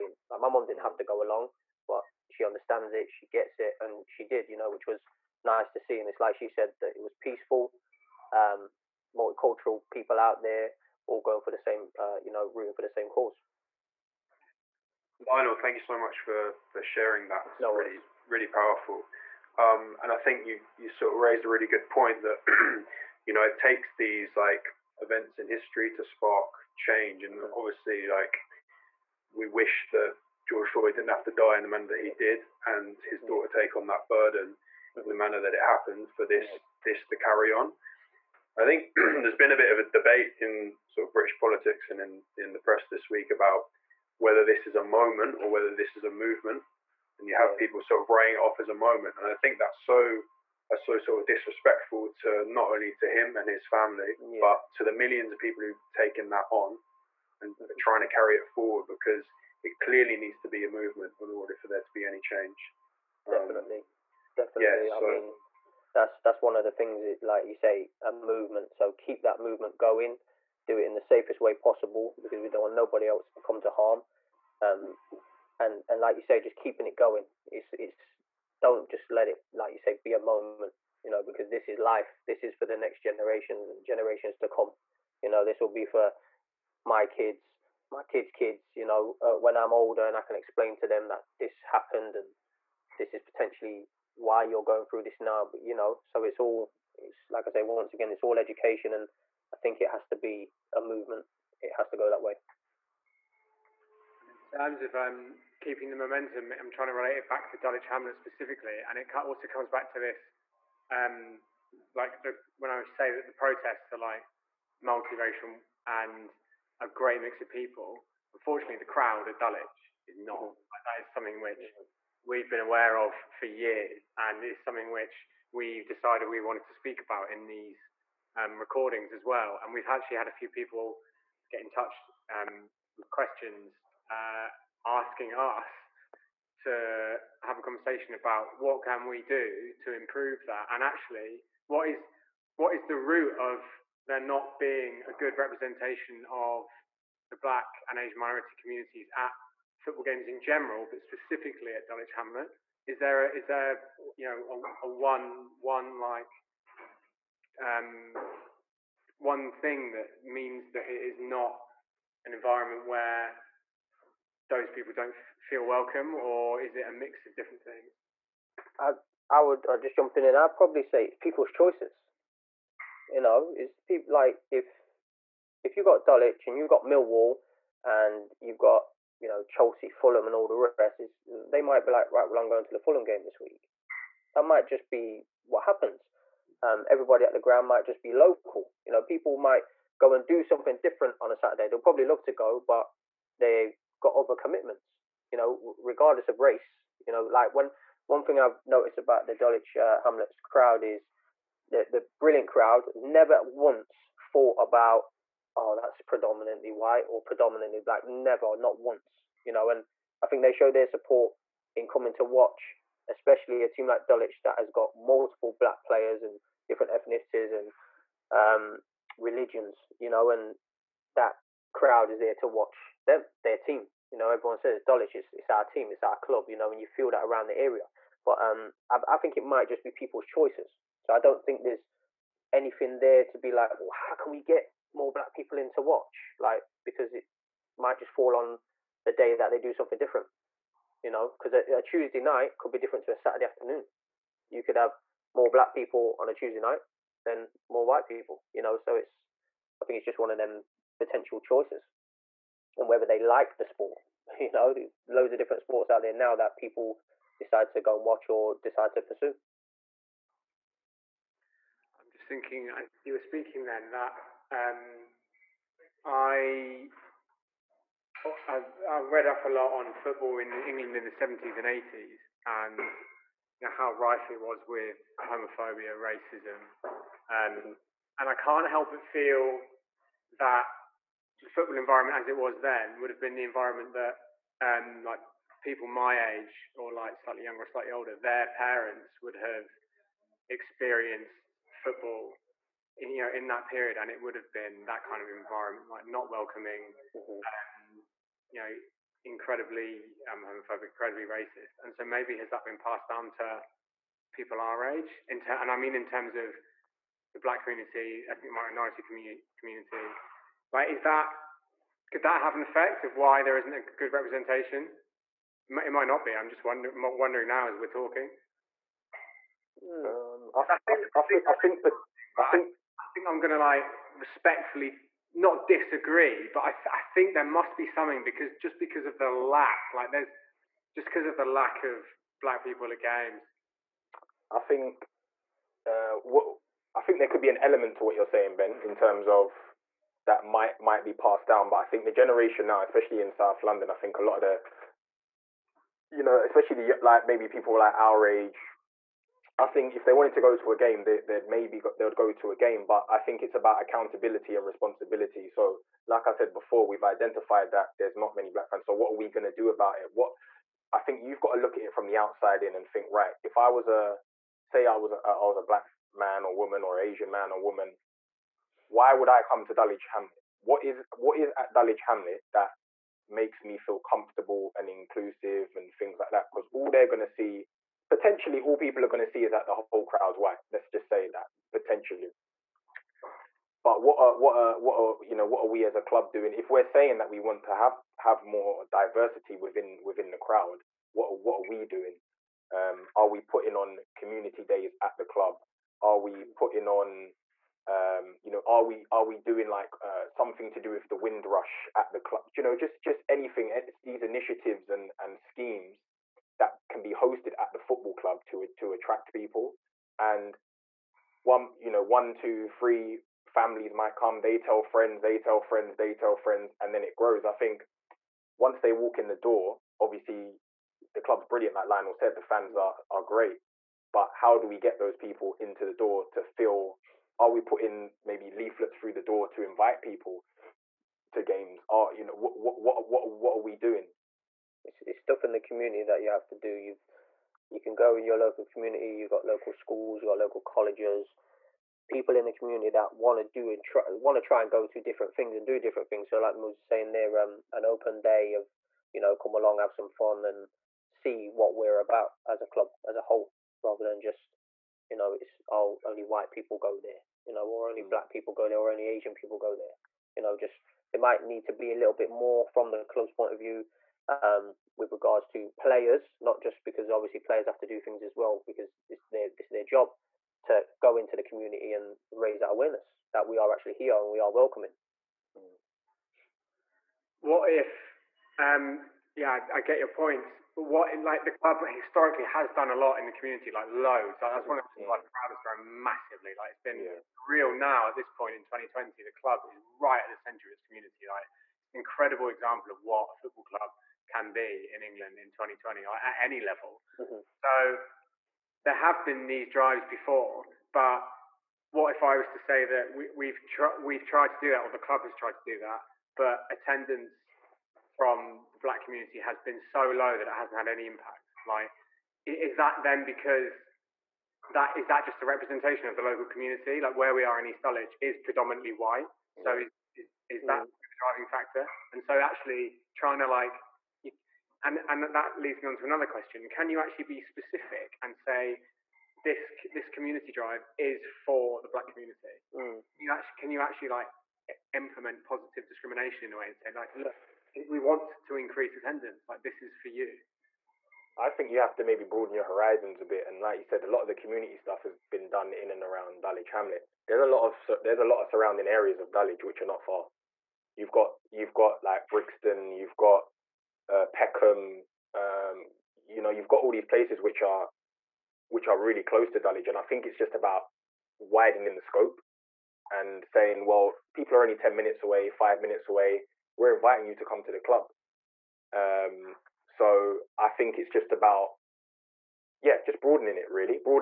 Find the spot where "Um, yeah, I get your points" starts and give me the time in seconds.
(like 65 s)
478 s.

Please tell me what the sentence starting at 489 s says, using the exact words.
The club is right at the centre of its community.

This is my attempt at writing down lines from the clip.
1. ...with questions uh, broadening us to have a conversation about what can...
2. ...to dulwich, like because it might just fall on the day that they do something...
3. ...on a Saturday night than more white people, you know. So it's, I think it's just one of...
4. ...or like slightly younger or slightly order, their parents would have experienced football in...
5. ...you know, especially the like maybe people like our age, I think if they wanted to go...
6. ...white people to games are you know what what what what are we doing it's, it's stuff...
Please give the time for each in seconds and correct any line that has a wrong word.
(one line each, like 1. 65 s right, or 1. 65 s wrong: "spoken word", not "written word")
1. 132 s wrong: "asking", not "broadening"
2. 235 s wrong: "watch", not "dulwich"
3. 246 s wrong: "Tuesday", not "Saturday"
4. 286 s wrong: "older", not "order"
5. 346 s right
6. 429 s wrong: "invite", not "white".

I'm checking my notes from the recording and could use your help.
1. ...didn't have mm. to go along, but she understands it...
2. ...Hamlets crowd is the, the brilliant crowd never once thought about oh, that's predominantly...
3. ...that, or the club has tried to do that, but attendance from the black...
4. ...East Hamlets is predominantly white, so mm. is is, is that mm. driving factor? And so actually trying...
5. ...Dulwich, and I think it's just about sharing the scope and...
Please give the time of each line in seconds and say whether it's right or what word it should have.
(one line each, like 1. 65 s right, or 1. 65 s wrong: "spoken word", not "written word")
1. 0 s right
2. 200 s right
3. 504 s right
4. 517 s wrong: "Dulwich", not "Hamlets"
5. 559 s wrong: "widening", not "sharing".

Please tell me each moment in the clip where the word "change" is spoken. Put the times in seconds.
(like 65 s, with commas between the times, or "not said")
26 s, 62 s.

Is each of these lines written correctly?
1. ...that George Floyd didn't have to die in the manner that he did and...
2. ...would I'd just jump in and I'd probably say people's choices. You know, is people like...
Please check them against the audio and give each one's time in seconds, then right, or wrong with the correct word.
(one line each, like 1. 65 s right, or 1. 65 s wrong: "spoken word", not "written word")
1. 29 s right
2. 169 s right.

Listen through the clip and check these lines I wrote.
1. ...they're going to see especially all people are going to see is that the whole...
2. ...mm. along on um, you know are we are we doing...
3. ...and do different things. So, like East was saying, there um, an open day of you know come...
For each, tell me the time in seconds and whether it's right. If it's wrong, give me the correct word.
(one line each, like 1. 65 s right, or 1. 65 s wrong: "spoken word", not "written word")
1. 376 s wrong: "potentially", not "especially"
2. 396 s wrong: "putting", not "along"
3. 445 s wrong: "Moses", not "East".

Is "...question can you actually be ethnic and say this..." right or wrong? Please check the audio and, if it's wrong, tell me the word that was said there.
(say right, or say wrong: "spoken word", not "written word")
wrong: "specific", not "ethnic".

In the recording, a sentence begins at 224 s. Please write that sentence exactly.
You know, everyone says Dulwich, it's, it's our team, it's our club, you know, and you feel that around the area.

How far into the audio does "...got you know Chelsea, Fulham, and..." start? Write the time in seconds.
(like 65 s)
178 s.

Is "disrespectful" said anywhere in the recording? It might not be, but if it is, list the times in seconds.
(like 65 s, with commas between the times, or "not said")
51 s.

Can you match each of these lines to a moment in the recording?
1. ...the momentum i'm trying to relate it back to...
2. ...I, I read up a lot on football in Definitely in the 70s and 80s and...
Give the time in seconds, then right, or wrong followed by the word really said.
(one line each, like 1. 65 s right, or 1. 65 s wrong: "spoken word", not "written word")
1. 105 s right
2. 268 s wrong: "England", not "Definitely".